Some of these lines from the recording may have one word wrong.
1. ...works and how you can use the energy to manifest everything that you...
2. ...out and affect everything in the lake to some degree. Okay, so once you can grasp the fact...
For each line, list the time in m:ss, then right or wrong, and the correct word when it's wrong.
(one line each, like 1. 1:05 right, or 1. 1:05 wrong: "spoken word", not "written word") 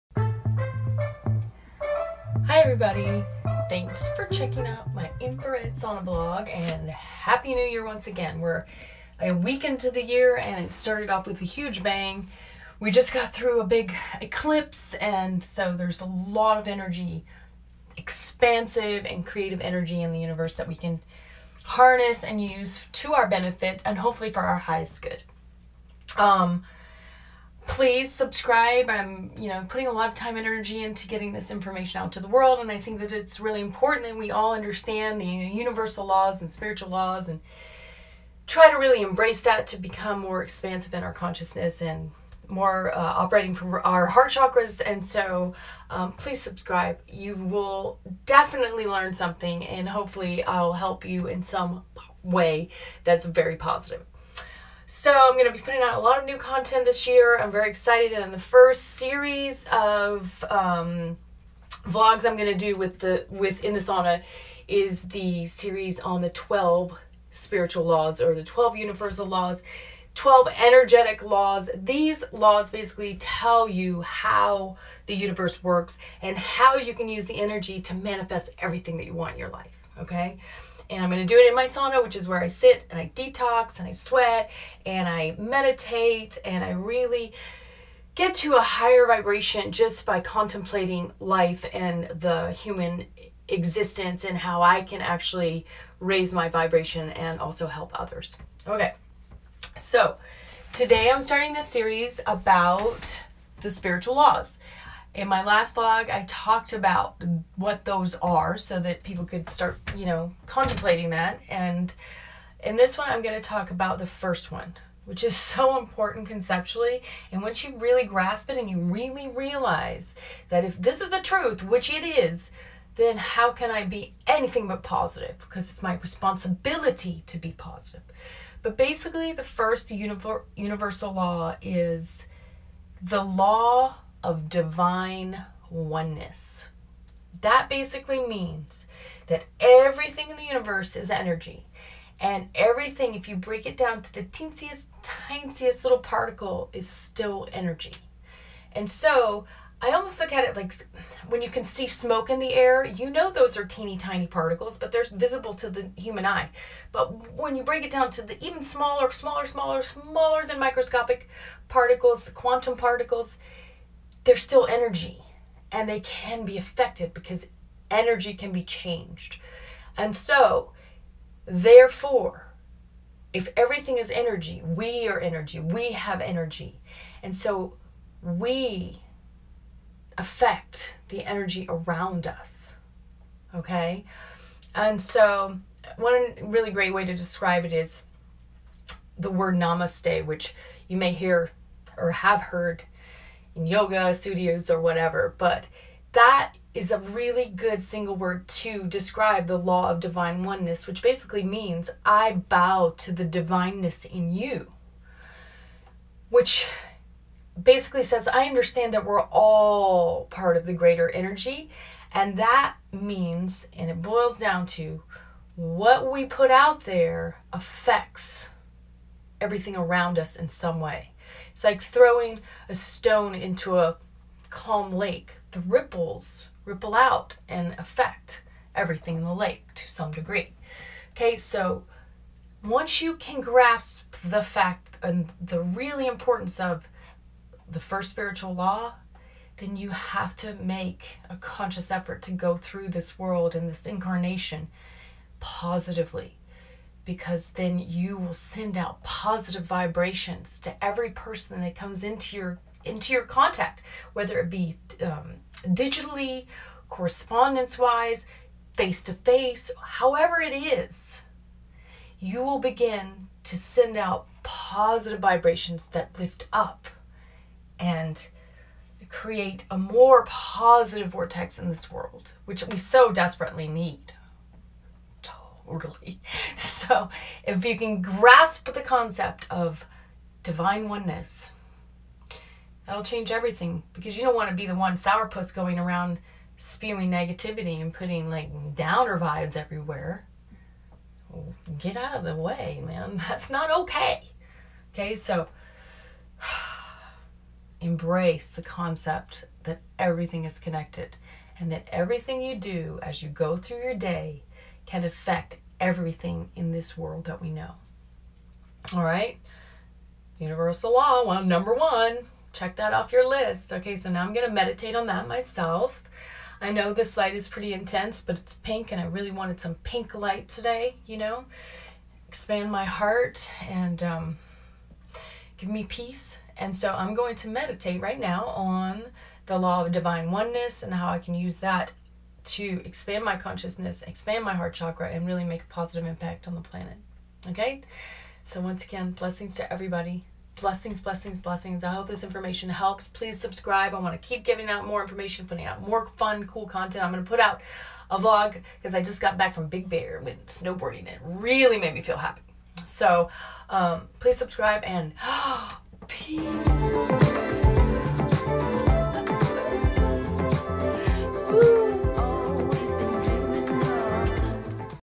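1. 1:15 right
2. 3:46 right.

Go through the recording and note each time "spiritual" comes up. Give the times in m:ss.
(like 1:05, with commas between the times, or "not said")
0:36, 1:07, 1:43, 3:58.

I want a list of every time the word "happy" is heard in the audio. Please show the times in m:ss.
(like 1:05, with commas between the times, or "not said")
0:06, 5:52.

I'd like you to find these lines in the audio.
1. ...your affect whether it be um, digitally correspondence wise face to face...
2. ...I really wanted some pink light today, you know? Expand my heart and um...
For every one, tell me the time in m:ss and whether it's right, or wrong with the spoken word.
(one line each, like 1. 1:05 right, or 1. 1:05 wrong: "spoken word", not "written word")
1. 4:13 wrong: "contact", not "affect"
2. 5:18 right.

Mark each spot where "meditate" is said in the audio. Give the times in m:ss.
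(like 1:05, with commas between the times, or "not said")
1:25, 5:14, 5:27.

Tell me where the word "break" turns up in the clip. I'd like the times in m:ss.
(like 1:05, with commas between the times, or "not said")
2:23, 2:37.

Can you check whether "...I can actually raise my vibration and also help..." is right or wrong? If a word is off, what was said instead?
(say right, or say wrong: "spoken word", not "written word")
right.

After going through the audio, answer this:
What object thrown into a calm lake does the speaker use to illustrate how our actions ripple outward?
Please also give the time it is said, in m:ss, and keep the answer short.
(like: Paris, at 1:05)
stone, at 3:42.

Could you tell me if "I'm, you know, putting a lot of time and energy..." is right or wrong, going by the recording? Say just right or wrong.
right.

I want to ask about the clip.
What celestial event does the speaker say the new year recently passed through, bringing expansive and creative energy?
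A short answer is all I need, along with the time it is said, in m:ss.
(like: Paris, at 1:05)
eclipse, at 0:14.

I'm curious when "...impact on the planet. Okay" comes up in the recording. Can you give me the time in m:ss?
5:36.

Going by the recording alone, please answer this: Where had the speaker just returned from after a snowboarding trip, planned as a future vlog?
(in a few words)
Big Bear.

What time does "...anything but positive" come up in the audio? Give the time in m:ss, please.
2:04.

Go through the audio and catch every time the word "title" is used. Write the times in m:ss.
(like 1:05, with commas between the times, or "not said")
not said.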